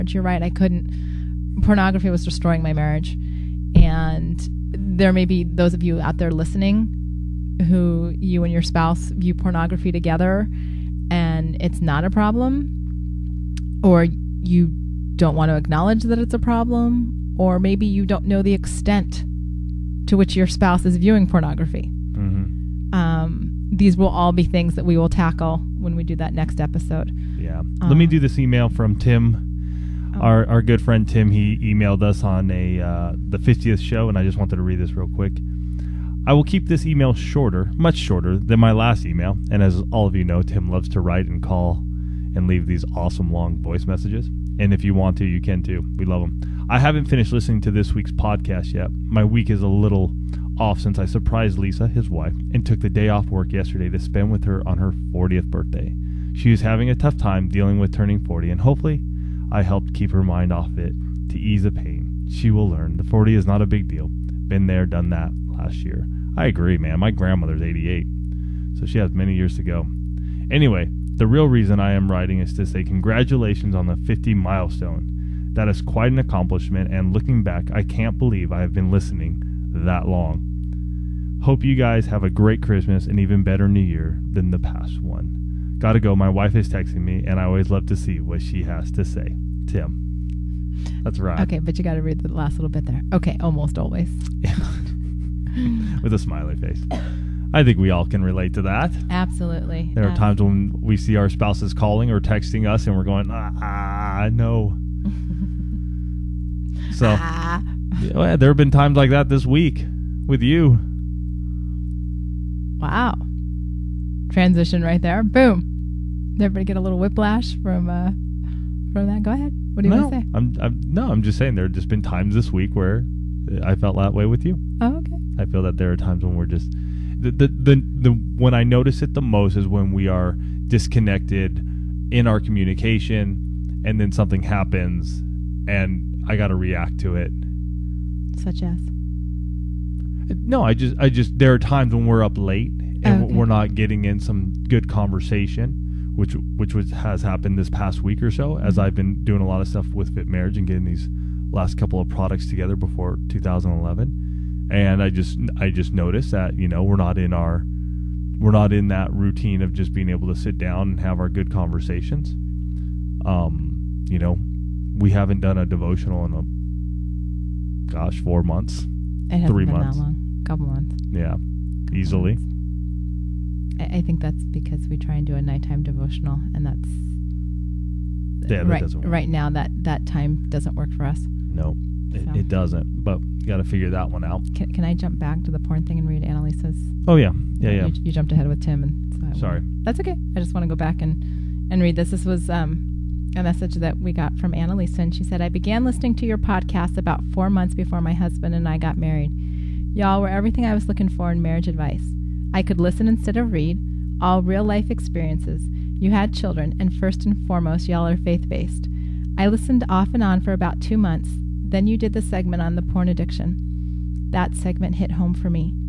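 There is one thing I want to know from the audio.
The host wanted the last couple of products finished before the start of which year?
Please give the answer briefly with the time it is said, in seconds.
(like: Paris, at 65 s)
2011, at 153 s.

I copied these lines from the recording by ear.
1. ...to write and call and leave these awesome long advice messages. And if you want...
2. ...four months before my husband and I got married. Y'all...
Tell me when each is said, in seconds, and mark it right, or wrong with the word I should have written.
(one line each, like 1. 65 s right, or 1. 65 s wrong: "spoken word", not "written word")
1. 40 s wrong: "voice", not "advice"
2. 197 s right.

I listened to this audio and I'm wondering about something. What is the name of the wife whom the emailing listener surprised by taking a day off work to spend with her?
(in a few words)
Lisa.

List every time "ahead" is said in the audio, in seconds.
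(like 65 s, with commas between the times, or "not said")
119 s, 188 s.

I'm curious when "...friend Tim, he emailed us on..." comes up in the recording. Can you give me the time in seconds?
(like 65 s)
30 s.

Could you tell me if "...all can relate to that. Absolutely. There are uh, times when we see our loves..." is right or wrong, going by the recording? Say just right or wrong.
wrong.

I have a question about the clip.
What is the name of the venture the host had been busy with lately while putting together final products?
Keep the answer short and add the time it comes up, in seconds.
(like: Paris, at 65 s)
Fit Marriage, at 150 s.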